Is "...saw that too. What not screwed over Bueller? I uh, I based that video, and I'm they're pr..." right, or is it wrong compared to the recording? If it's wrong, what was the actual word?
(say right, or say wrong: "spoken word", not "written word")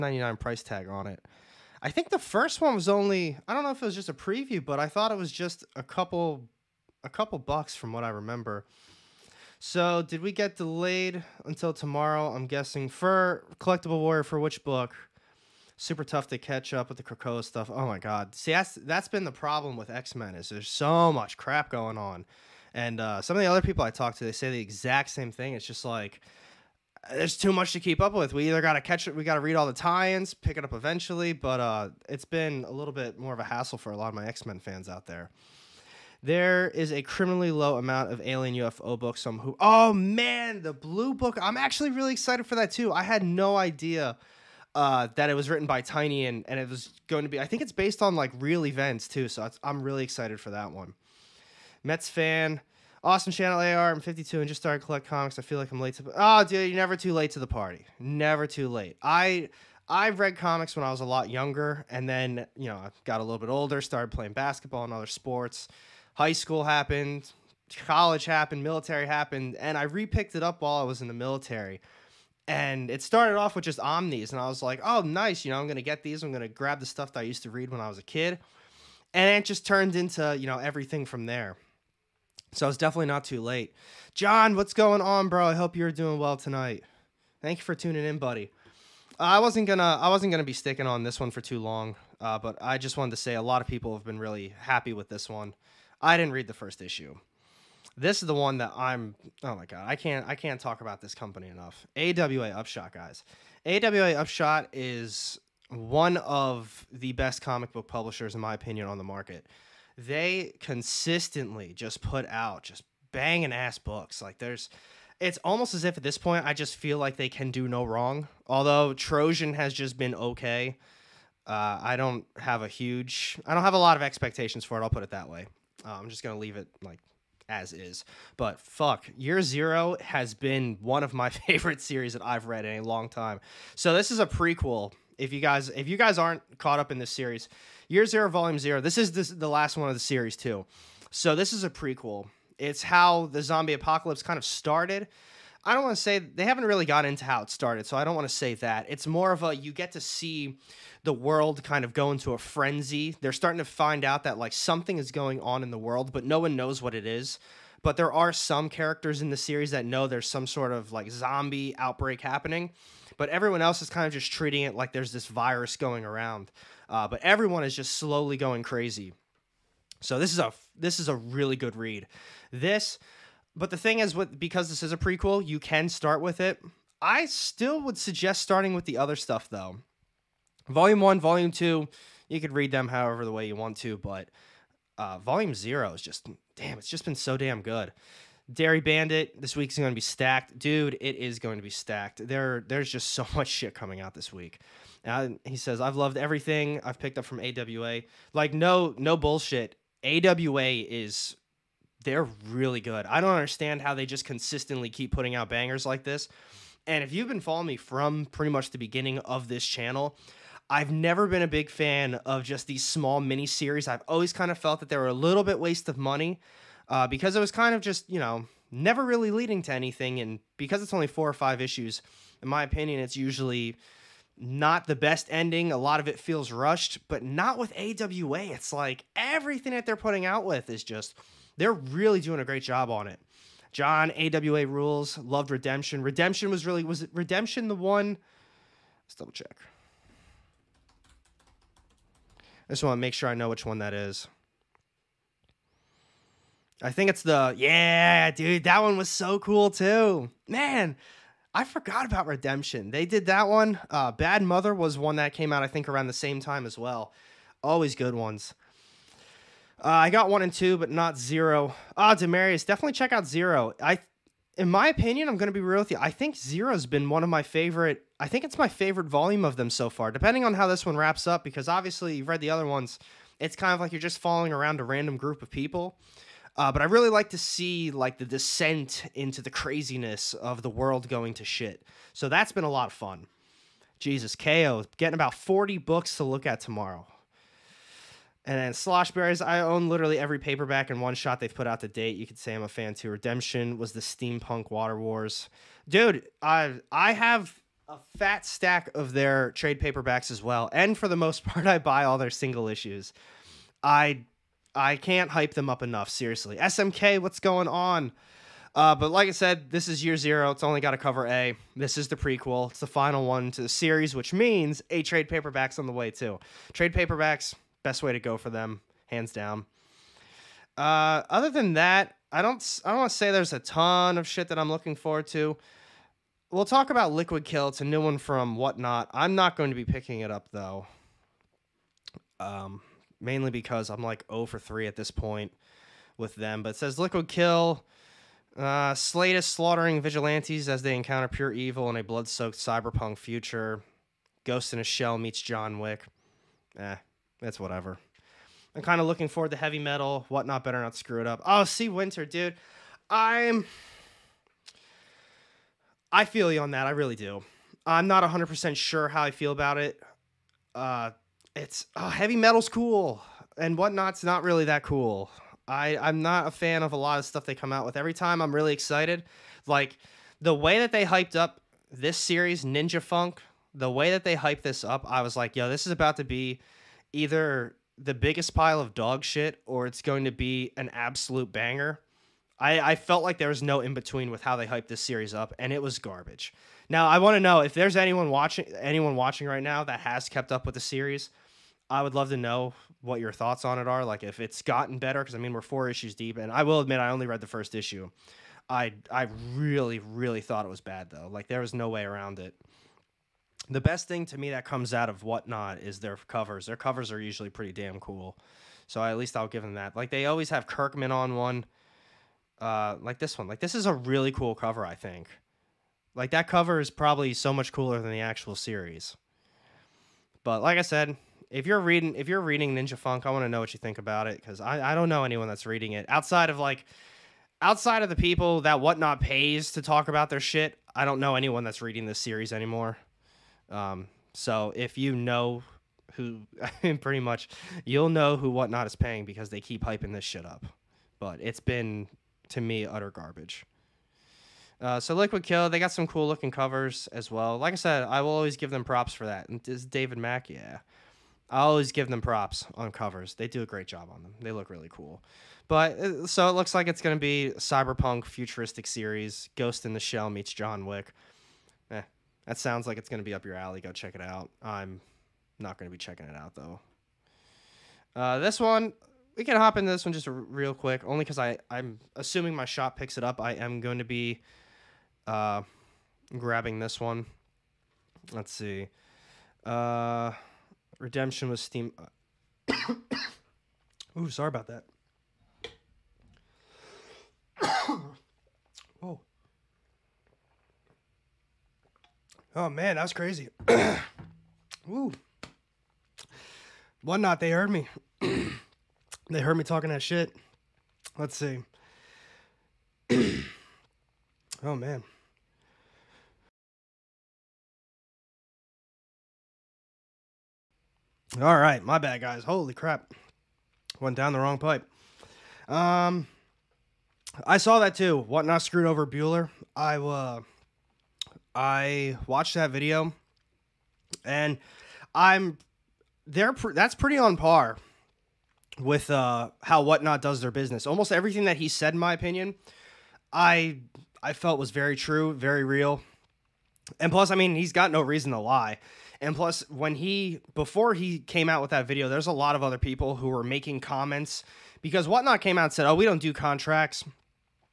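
wrong: "watched", not "based".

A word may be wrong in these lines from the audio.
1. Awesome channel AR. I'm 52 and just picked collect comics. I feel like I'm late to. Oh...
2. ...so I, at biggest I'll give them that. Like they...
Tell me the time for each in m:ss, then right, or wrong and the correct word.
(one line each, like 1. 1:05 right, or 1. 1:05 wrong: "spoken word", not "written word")
1. 0:53 wrong: "started", not "picked"
2. 6:48 wrong: "least", not "biggest".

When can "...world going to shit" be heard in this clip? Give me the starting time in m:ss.
4:40.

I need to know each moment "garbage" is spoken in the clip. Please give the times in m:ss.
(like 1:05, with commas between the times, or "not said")
6:25, 7:23.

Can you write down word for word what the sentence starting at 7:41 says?
Eh, that sounds like it's going to be up your alley.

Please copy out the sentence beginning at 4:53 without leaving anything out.
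Redemption was the steampunk Water Wars.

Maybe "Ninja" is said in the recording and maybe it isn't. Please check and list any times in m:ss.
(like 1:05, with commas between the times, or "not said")
6:12, 7:02.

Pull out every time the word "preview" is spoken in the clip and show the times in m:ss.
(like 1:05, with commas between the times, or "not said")
0:04.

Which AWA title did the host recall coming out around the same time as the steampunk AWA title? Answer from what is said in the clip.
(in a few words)
Bad Mother.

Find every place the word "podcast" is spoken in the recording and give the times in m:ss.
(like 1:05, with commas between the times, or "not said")
not said.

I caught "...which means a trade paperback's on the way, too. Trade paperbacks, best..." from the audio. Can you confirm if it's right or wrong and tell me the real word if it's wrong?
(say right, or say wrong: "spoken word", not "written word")
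right.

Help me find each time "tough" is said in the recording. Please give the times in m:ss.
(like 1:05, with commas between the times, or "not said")
0:16.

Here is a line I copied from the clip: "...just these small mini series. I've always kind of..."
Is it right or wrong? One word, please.
right.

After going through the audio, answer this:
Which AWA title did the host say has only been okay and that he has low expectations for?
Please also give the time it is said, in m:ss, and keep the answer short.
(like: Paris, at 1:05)
Trojan, at 1:58.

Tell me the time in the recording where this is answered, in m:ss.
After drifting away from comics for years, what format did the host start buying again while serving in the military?
1:13.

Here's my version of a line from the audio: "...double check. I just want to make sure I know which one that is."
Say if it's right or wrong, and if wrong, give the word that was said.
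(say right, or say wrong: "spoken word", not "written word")
right.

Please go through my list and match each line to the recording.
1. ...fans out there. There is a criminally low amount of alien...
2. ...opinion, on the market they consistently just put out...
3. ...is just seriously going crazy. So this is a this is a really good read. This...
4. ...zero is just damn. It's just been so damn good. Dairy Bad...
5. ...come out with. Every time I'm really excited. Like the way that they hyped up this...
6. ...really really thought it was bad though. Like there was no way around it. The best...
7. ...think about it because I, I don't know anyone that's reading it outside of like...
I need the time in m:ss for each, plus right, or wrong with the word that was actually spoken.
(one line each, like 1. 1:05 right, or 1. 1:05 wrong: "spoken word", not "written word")
1. 0:34 right
2. 1:48 right
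3. 2:47 wrong: "slowly", not "seriously"
4. 3:05 wrong: "Bandit", not "Bad"
5. 6:07 right
6. 6:39 right
7. 7:03 right.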